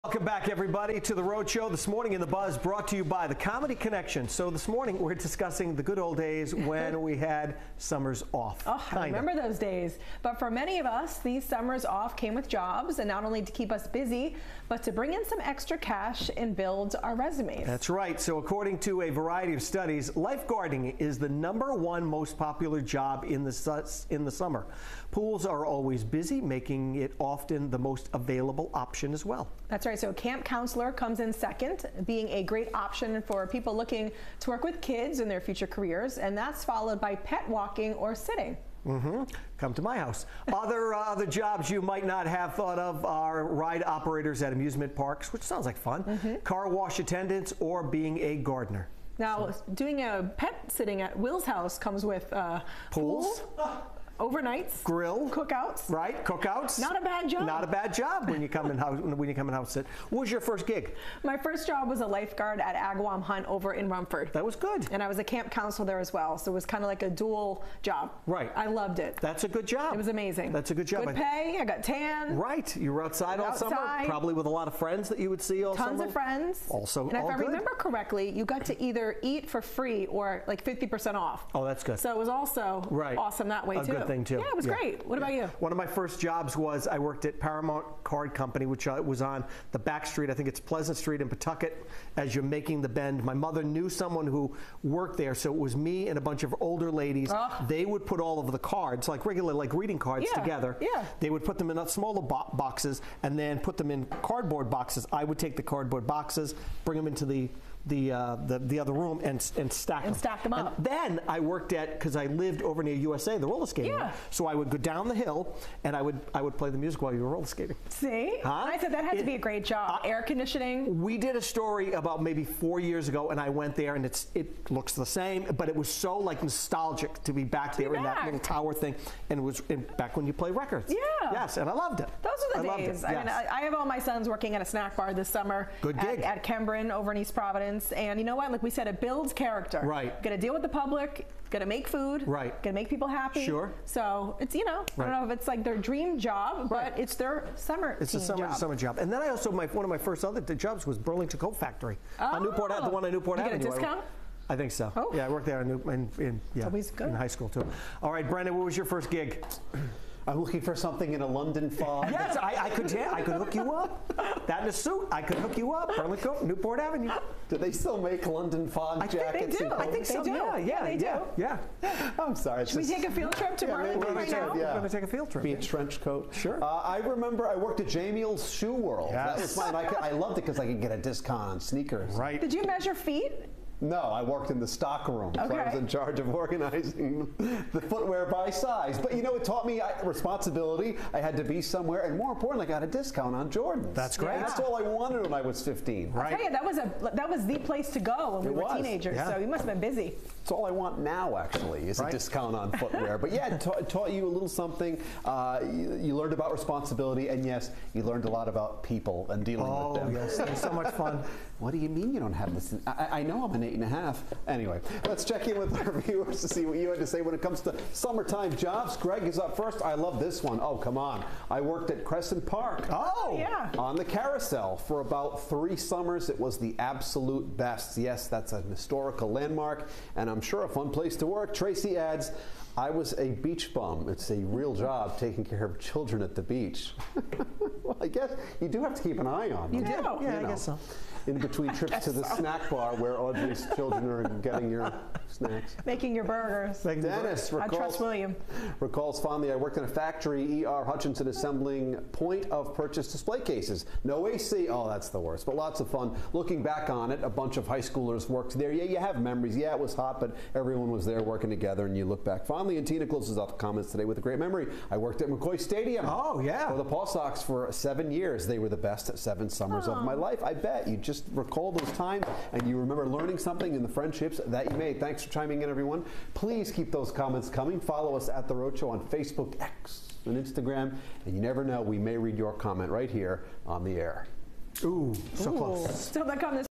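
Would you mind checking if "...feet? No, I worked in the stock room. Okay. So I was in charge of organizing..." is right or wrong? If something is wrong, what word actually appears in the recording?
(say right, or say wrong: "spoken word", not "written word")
right.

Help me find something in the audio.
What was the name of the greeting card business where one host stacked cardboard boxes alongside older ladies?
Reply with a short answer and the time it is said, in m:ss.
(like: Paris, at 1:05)
Paramount Card Company, at 1:27.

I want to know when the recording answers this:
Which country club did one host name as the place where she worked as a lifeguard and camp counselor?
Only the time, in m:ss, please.
1:02.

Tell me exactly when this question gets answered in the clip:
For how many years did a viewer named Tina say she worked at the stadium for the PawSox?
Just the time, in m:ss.
4:27.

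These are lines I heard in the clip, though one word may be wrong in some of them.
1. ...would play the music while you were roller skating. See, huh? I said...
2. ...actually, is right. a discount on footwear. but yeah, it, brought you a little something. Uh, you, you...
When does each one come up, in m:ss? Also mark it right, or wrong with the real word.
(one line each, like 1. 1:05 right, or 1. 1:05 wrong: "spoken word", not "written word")
1. 1:56 right
2. 3:21 wrong: "taught", not "brought".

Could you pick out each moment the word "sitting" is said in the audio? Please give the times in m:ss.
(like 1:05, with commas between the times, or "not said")
0:38, 0:50.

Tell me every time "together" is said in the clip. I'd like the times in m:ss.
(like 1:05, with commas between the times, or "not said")
1:40, 4:21.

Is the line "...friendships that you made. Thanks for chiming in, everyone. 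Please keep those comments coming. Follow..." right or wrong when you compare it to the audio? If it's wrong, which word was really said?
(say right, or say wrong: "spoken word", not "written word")
right.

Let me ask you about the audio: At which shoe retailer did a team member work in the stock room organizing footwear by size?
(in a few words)
Jamie's Shoe World.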